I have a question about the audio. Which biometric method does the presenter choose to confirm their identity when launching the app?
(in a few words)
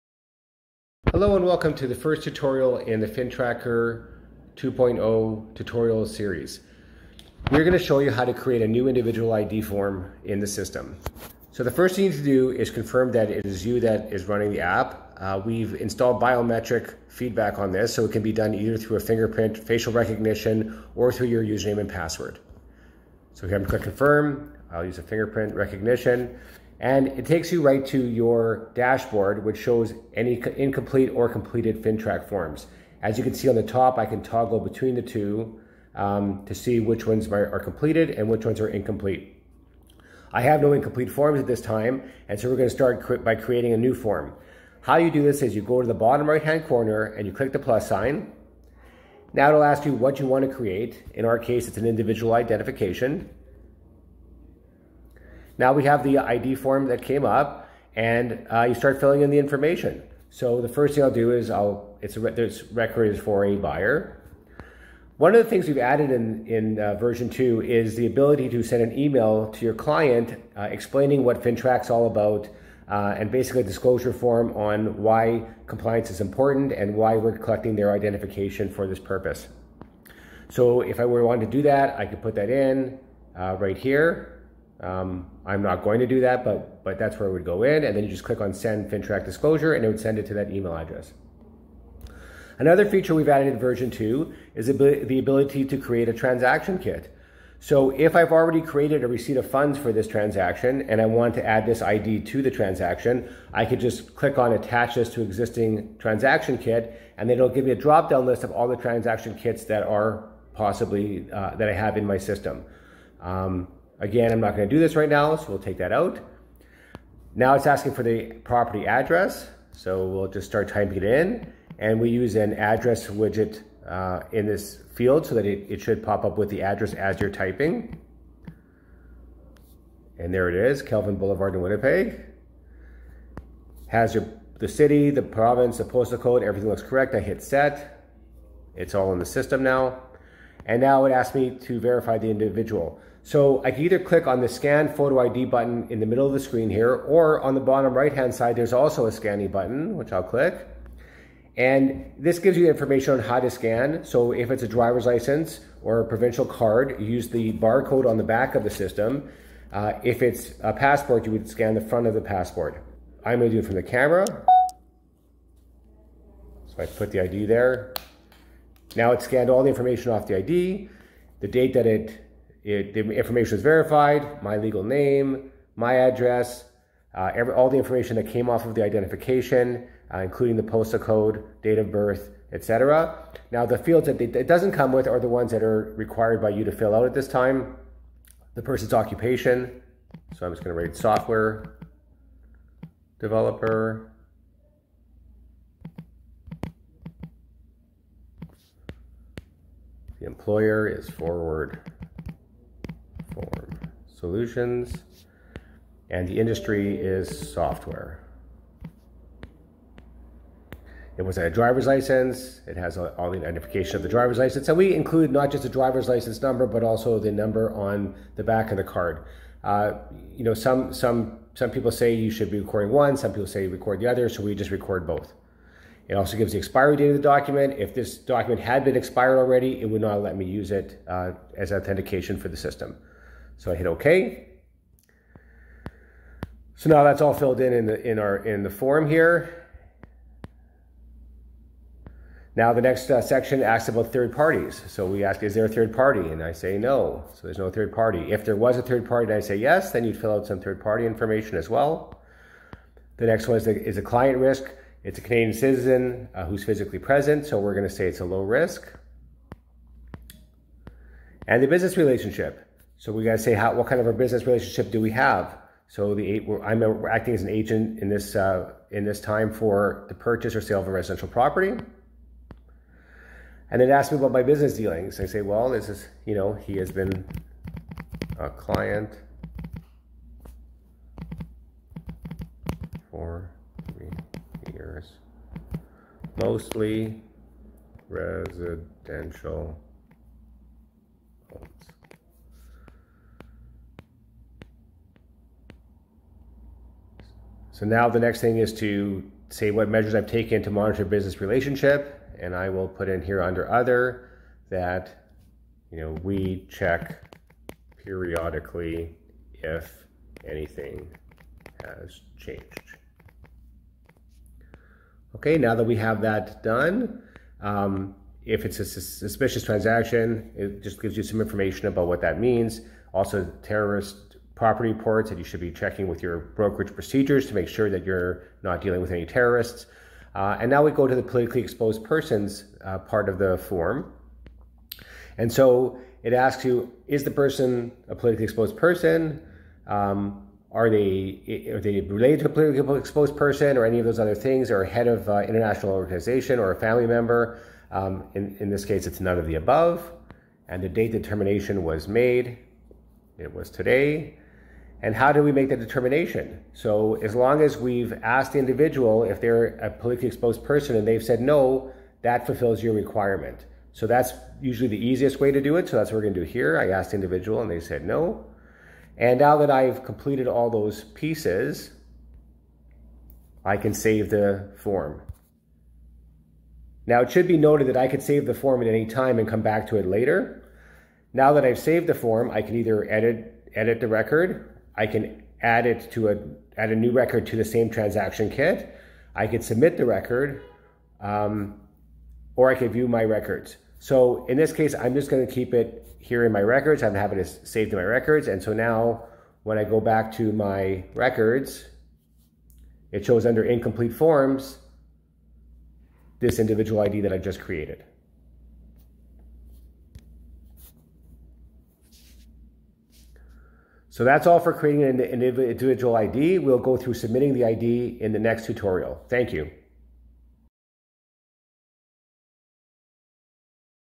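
Fingerprint recognition.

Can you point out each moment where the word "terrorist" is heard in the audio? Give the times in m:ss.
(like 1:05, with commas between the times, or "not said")
5:23, 5:29.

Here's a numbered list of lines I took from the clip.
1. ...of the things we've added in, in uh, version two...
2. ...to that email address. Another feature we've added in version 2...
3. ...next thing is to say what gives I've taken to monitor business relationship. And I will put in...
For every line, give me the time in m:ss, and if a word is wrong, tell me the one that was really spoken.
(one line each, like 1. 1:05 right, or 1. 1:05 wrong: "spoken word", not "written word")
1. 1:05 right
2. 1:30 right
3. 4:58 wrong: "measures", not "gives".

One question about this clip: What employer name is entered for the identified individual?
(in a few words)
Forward Solutions.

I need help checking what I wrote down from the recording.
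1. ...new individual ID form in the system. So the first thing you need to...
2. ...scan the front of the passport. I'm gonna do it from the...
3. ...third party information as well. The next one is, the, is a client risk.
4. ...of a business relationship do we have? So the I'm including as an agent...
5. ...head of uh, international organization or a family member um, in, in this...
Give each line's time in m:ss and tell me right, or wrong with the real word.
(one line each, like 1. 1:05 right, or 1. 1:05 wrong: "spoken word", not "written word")
1. 0:08 right
2. 2:41 right
3. 4:10 right
4. 4:23 wrong: "acting", not "including"
5. 5:44 right.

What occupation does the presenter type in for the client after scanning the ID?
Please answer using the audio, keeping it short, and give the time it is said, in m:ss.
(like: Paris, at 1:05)
Software developer, at 3:10.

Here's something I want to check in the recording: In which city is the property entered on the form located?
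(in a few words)
Winnipeg.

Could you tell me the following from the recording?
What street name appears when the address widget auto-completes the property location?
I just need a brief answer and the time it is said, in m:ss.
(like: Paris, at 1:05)
Kelvin Boulevard, at 2:10.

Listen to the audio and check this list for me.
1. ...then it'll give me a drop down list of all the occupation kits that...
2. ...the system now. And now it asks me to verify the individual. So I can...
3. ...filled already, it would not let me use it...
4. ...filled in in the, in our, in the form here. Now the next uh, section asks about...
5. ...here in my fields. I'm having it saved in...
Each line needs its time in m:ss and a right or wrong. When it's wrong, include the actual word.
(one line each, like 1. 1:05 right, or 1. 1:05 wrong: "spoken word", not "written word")
1. 1:47 wrong: "transaction", not "occupation"
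2. 2:19 right
3. 3:48 wrong: "expired", not "filled"
4. 3:57 right
5. 6:36 wrong: "records", not "fields".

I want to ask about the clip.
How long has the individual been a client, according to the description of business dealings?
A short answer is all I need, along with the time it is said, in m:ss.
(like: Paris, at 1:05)
3 years, at 4:43.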